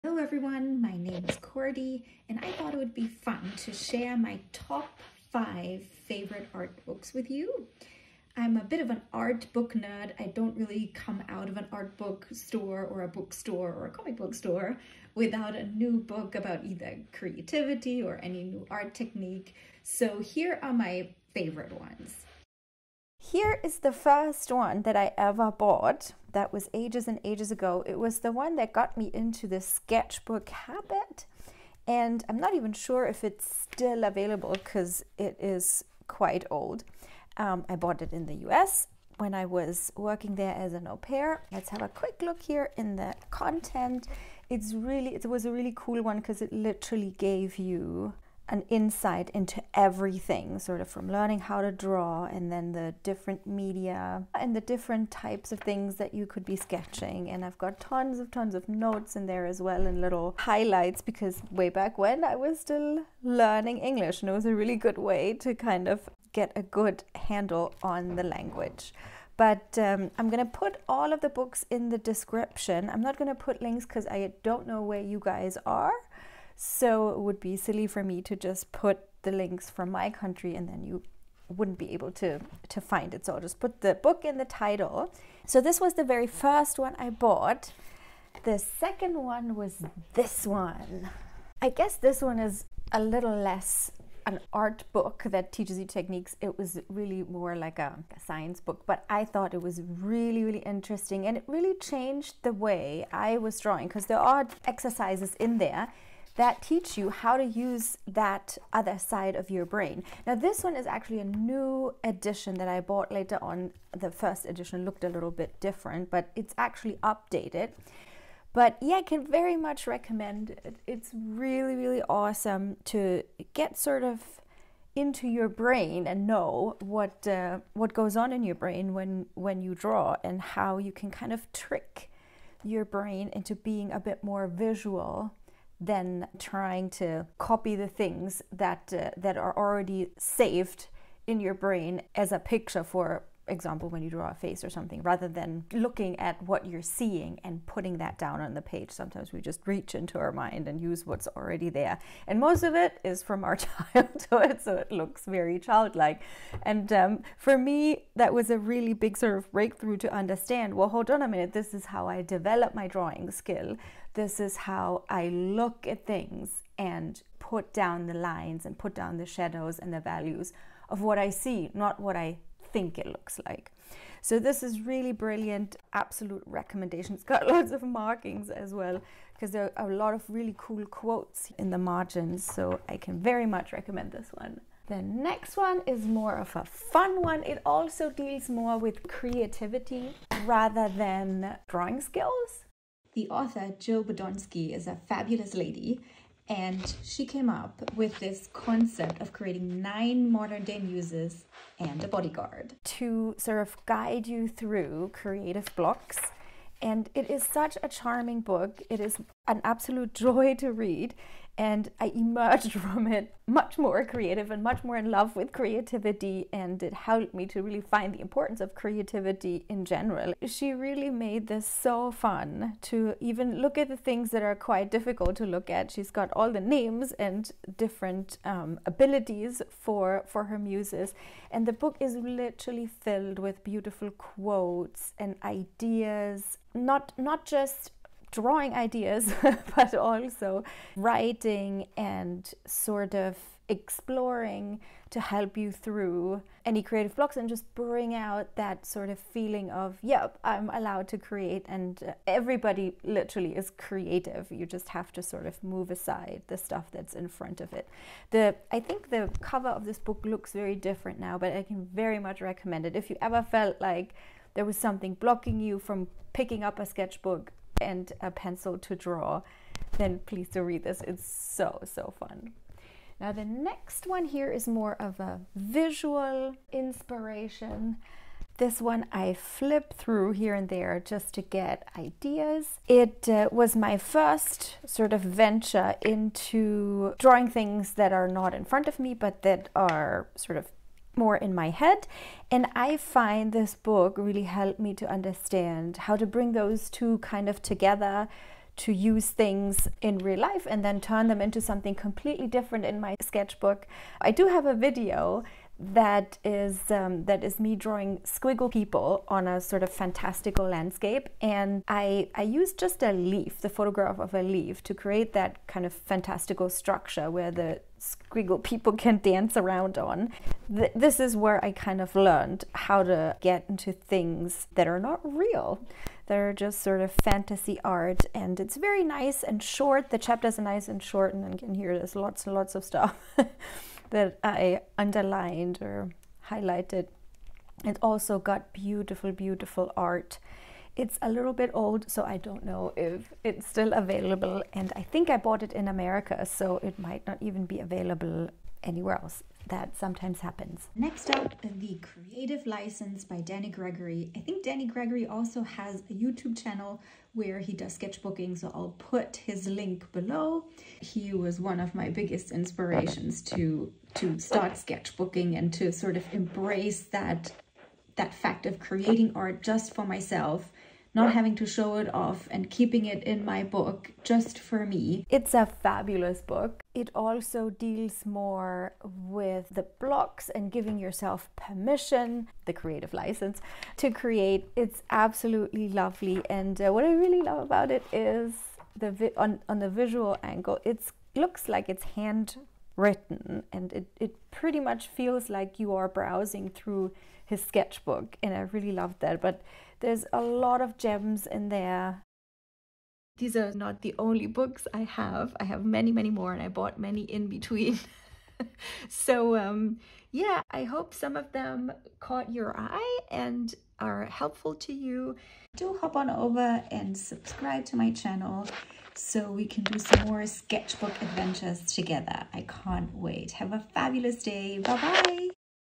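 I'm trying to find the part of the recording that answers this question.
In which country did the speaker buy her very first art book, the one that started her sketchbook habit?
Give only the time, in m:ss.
0:38.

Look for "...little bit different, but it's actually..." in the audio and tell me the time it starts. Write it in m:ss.
1:55.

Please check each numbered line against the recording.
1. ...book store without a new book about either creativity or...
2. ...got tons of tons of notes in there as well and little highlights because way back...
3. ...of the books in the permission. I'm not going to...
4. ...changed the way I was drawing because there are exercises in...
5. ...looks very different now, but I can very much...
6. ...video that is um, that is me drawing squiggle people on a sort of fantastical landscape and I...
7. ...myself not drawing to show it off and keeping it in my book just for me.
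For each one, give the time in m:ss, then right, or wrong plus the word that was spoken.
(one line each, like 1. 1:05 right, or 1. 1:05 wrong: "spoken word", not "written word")
1. 0:14 right
2. 0:57 right
3. 1:11 wrong: "description", not "permission"
4. 1:41 right
5. 4:20 right
6. 5:04 right
7. 6:10 wrong: "having", not "drawing".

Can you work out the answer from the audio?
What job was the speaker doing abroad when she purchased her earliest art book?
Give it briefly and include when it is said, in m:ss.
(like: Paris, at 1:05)
au pair, at 0:40.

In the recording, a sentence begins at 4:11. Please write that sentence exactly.
And uh, everybody literally is creative.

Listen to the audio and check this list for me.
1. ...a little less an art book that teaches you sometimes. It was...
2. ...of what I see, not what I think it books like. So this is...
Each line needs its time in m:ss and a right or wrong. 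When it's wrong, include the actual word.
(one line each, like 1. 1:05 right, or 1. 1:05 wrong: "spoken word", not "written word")
1. 1:32 wrong: "techniques", not "sometimes"
2. 2:50 wrong: "looks", not "books".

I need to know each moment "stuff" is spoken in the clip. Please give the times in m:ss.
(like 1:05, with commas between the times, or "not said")
4:16, 5:32.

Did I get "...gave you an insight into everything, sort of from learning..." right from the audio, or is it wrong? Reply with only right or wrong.
right.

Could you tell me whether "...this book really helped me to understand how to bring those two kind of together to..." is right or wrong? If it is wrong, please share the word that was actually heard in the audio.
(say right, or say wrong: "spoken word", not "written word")
right.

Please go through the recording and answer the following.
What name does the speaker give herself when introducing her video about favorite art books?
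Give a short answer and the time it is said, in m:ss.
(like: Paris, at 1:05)
Cordi, at 0:01.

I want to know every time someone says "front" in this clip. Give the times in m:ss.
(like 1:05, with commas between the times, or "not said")
4:17, 4:48.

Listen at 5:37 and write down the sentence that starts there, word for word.
It also got beautiful, beautiful art.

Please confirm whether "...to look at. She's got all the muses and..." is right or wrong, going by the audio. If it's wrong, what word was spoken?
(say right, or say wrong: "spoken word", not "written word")
wrong: "names", not "muses".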